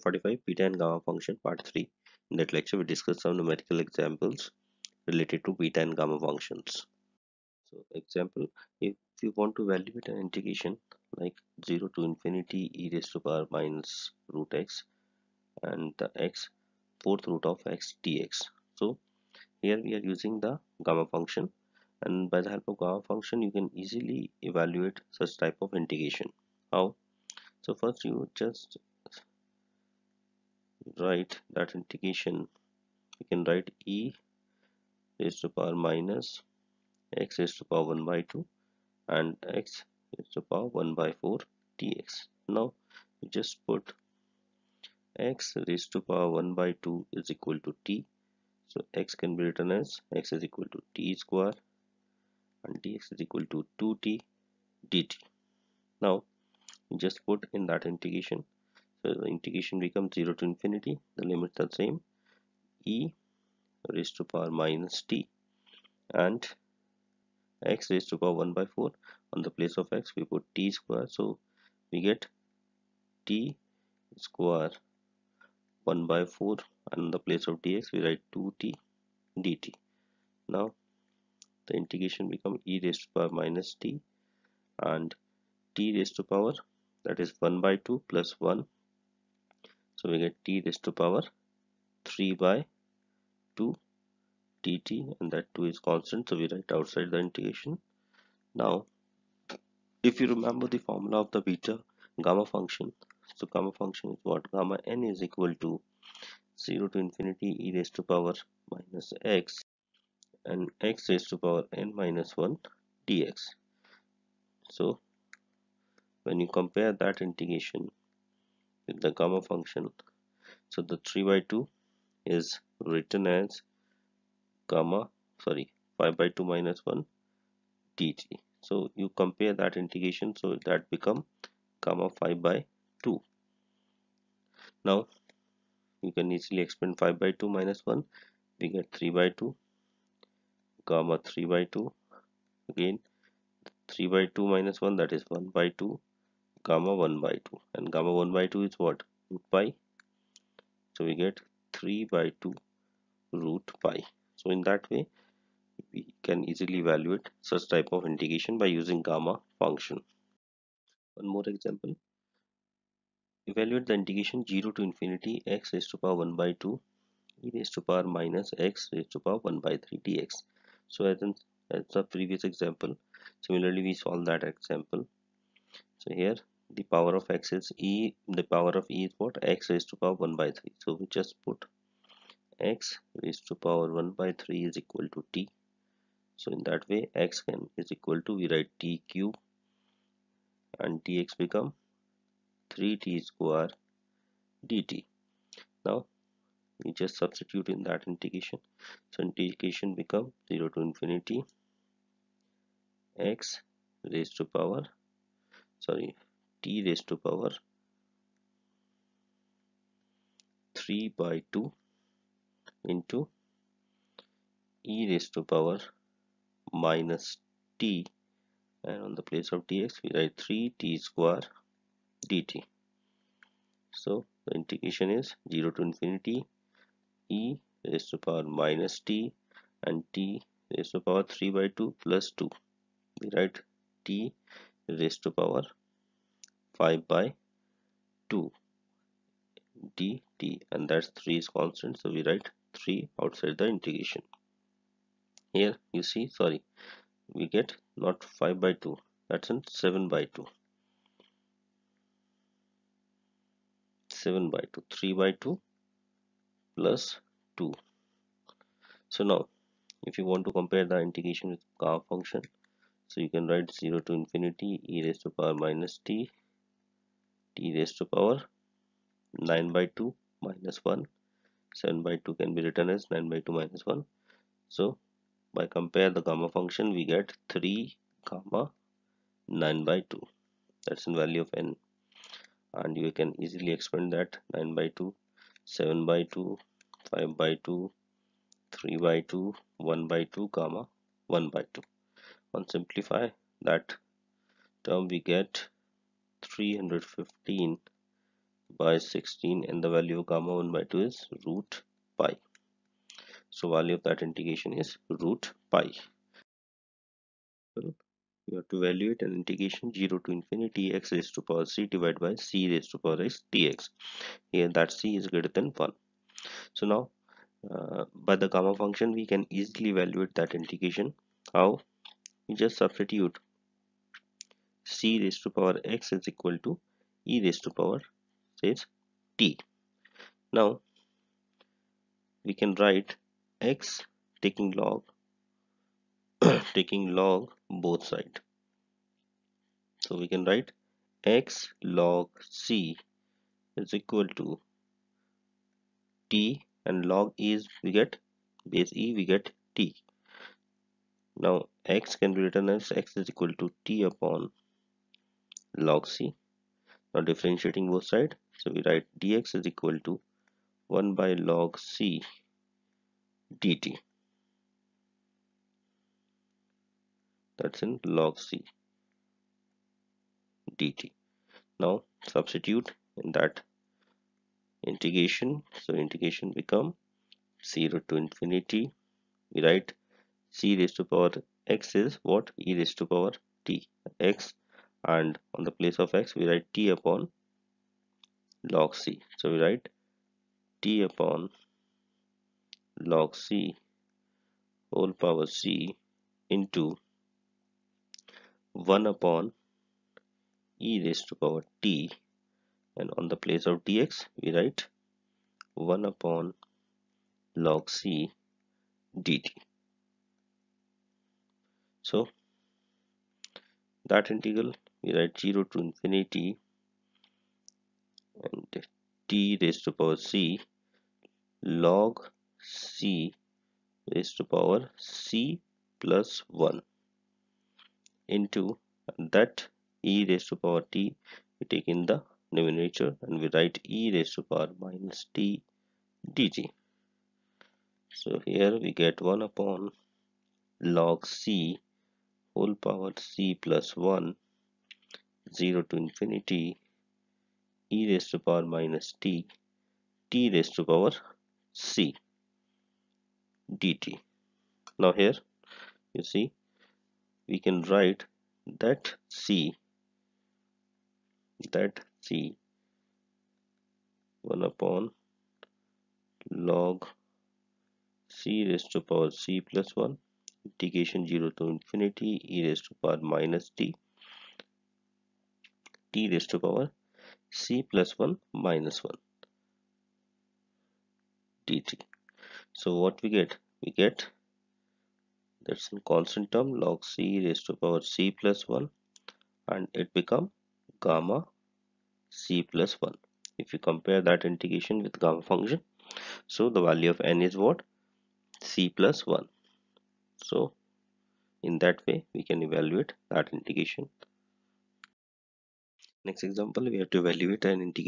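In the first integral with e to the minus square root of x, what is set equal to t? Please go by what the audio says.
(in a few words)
x^(1/2).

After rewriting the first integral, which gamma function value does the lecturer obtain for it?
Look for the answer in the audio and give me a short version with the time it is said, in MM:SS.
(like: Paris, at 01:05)
gamma 5/2, at 02:11.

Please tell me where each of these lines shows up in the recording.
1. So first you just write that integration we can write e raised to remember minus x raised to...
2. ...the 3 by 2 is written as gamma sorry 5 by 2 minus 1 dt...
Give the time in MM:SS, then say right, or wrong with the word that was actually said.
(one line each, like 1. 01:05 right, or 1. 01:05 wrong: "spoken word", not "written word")
1. 00:27 wrong: "power", not "remember"
2. 02:00 right.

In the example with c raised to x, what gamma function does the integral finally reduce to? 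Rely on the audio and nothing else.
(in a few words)
gamma c+1.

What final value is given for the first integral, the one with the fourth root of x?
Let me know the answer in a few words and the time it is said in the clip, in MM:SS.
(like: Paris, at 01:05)
3/2 root pi, at 02:31.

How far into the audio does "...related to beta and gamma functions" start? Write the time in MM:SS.
00:05.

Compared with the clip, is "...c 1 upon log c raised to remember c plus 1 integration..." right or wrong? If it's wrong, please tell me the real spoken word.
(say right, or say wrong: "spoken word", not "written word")
wrong: "power", not "remember".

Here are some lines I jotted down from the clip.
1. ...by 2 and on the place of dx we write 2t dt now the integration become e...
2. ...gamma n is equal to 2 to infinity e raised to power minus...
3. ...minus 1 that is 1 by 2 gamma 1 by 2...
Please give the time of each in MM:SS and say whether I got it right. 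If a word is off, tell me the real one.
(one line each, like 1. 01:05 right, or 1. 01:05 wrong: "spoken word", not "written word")
1. 01:16 wrong: "4", not "2"
2. 01:44 wrong: "0", not "2"
3. 02:24 right.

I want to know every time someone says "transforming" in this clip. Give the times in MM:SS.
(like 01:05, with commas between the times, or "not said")
not said.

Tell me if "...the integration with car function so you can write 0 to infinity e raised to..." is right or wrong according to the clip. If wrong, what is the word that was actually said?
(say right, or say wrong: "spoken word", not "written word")
right.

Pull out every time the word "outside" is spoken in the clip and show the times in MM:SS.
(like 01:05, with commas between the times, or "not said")
01:36, 04:03.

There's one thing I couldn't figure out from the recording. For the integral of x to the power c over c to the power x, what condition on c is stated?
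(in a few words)
greater than 1.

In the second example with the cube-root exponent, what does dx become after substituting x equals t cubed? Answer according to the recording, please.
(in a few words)
3t^2 dt.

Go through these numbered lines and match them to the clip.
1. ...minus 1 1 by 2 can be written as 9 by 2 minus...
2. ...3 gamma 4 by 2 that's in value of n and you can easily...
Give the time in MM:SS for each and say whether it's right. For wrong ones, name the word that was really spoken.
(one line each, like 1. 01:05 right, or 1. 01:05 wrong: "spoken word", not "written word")
1. 04:30 wrong: "7", not "1"
2. 04:37 wrong: "9", not "4".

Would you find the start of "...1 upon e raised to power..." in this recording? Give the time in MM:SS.
06:38.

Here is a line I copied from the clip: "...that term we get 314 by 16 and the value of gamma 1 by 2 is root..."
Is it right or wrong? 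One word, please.
wrong.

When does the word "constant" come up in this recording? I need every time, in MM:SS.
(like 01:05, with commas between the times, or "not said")
01:35, 04:01, 08:06.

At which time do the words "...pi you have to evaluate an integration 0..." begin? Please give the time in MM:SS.
05:05.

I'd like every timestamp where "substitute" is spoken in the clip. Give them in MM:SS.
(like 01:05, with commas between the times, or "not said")
03:17, 05:22, 06:12.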